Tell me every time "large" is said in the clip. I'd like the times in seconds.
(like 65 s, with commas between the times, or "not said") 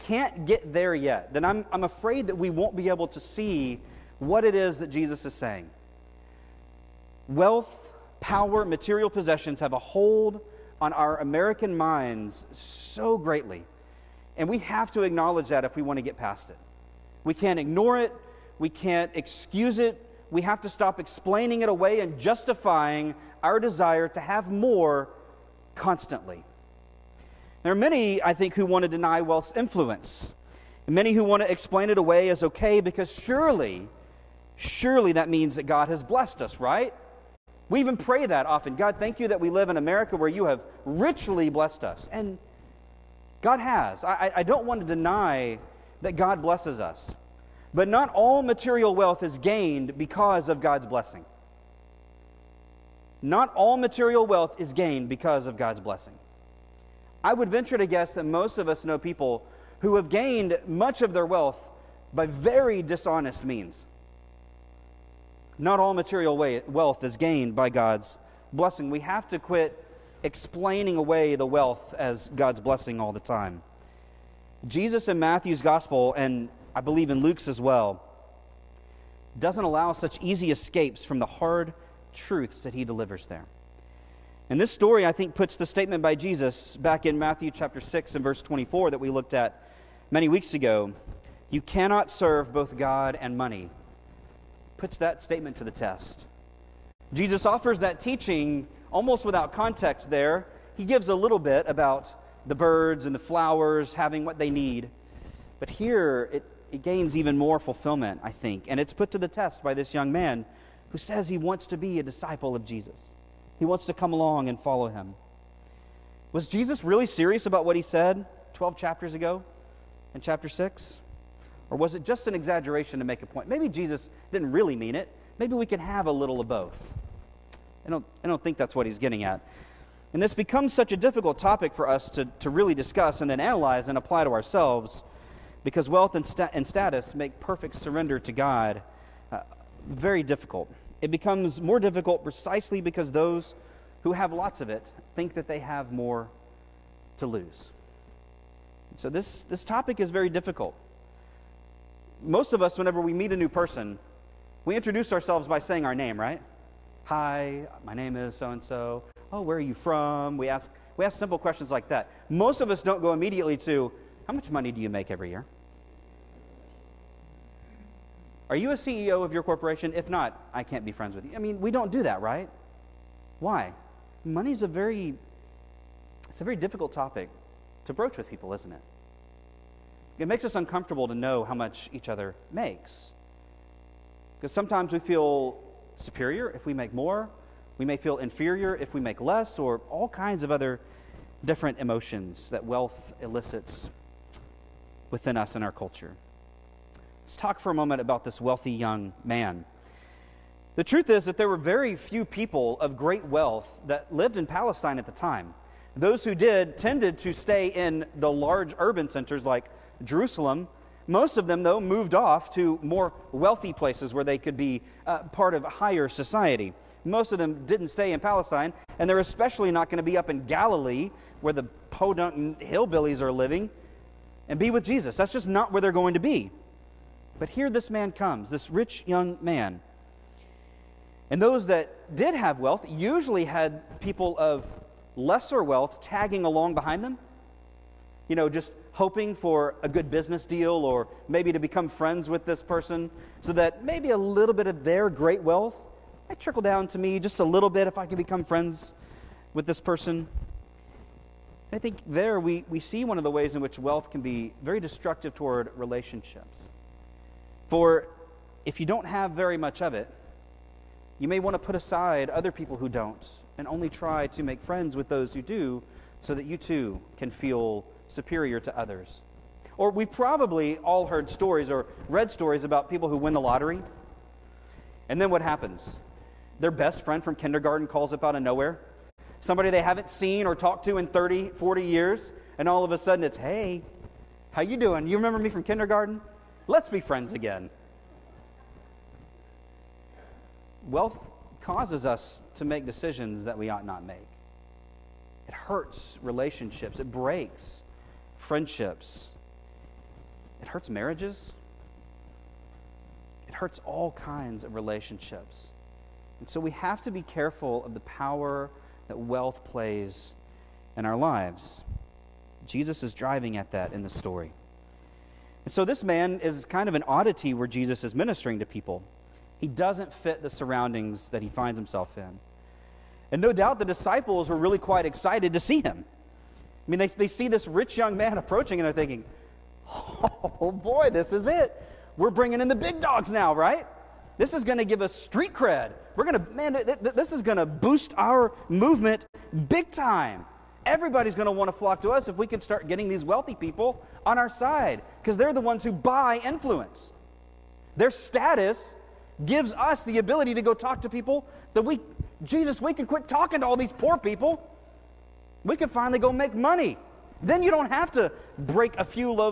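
208 s.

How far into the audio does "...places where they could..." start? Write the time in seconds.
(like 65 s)
213 s.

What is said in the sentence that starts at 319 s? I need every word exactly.
He doesn't fit the surroundings that he finds himself in.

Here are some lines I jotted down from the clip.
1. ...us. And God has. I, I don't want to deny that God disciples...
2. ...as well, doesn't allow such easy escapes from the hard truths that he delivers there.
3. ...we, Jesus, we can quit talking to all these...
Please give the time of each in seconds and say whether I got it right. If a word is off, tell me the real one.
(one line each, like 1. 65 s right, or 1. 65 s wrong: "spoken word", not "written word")
1. 41 s wrong: "blesses", not "disciples"
2. 77 s right
3. 351 s right.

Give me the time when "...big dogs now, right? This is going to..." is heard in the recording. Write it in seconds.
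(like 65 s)
332 s.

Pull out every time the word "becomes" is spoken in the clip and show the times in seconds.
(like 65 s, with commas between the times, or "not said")
130 s, 141 s, 241 s, 248 s.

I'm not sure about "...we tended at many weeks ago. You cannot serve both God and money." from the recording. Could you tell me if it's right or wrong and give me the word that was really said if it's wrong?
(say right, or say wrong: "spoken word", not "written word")
wrong: "looked", not "tended".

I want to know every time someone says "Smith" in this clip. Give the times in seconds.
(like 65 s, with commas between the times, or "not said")
not said.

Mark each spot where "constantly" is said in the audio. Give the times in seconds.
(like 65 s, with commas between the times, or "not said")
25 s.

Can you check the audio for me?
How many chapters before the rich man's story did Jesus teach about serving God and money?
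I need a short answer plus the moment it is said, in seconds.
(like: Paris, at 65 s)
12, at 118 s.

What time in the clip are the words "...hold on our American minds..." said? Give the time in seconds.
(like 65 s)
9 s.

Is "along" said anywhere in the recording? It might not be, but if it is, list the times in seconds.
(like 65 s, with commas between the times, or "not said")
114 s, 236 s.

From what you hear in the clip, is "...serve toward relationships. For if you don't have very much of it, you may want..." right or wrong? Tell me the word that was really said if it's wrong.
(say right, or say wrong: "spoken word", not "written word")
wrong: "destructive", not "serve".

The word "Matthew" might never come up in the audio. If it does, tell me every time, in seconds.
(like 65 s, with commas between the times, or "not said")
75 s, 87 s.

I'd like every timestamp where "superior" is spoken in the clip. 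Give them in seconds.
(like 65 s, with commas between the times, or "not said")
185 s, 268 s.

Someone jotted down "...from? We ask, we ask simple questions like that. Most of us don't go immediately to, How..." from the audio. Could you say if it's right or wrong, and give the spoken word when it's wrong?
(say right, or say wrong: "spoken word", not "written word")
right.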